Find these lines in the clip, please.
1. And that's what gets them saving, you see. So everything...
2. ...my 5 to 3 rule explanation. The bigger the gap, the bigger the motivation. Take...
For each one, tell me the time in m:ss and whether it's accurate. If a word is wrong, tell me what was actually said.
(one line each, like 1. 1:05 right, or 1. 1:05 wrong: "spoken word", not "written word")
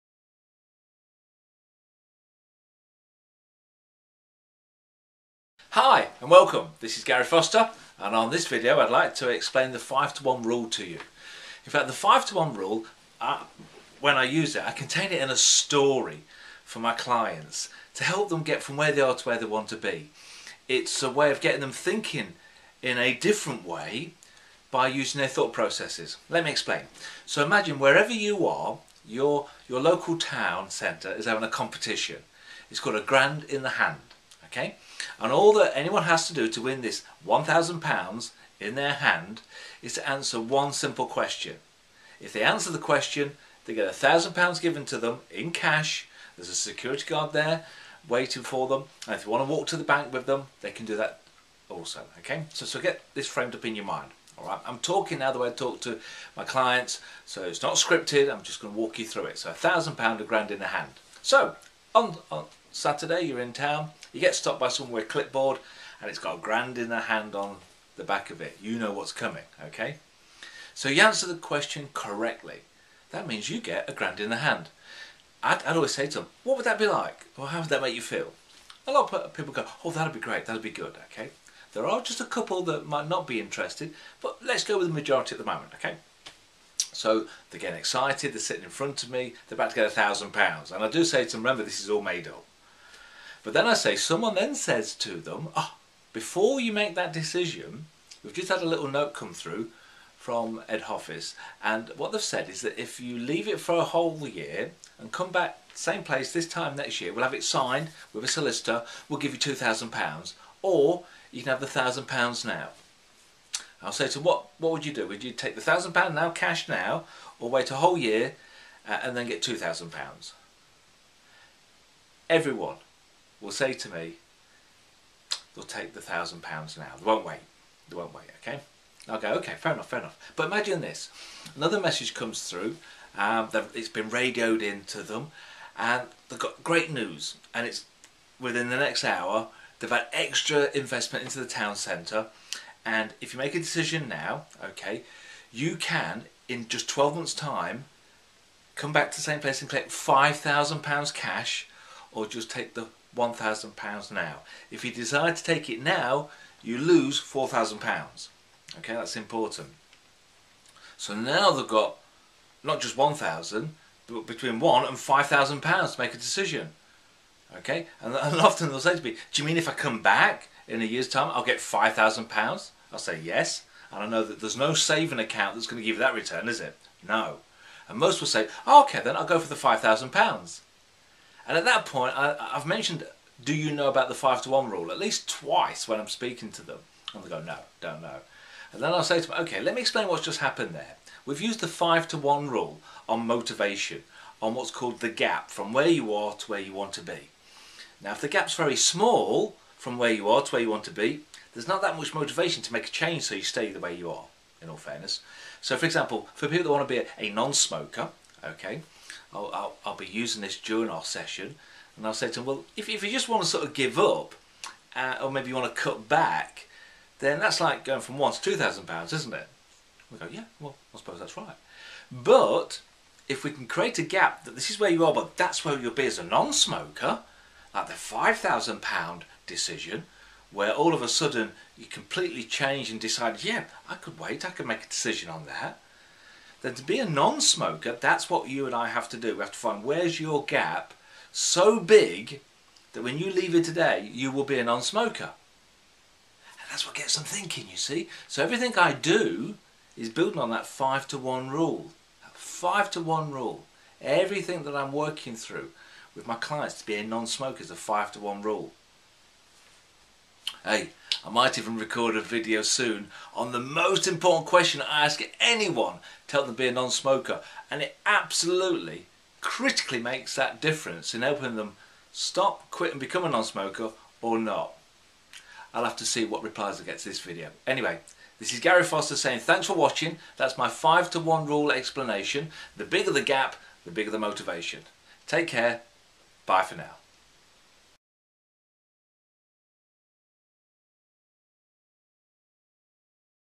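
1. 4:05 wrong: "thinking", not "saving"
2. 4:40 wrong: "1", not "3".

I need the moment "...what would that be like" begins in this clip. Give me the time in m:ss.
1:16.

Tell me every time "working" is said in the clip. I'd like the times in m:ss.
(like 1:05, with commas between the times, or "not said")
4:14.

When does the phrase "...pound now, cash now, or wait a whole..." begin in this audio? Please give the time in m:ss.
1:55.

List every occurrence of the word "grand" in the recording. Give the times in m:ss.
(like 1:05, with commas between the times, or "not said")
0:32, 1:00, 1:06, 1:13.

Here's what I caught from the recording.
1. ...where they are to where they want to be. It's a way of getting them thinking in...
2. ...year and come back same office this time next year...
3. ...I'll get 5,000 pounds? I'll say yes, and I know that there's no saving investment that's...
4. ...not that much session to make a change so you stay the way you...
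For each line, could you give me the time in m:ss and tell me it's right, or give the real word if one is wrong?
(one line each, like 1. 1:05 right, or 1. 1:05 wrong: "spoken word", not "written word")
1. 0:18 right
2. 1:44 wrong: "place", not "office"
3. 2:51 wrong: "account", not "investment"
4. 3:21 wrong: "motivation", not "session".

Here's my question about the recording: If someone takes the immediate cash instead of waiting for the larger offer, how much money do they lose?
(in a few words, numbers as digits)
£4,000.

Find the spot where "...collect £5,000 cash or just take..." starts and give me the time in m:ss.
2:29.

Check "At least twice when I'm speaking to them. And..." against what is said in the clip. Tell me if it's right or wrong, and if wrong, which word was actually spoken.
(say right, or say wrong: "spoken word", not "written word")
right.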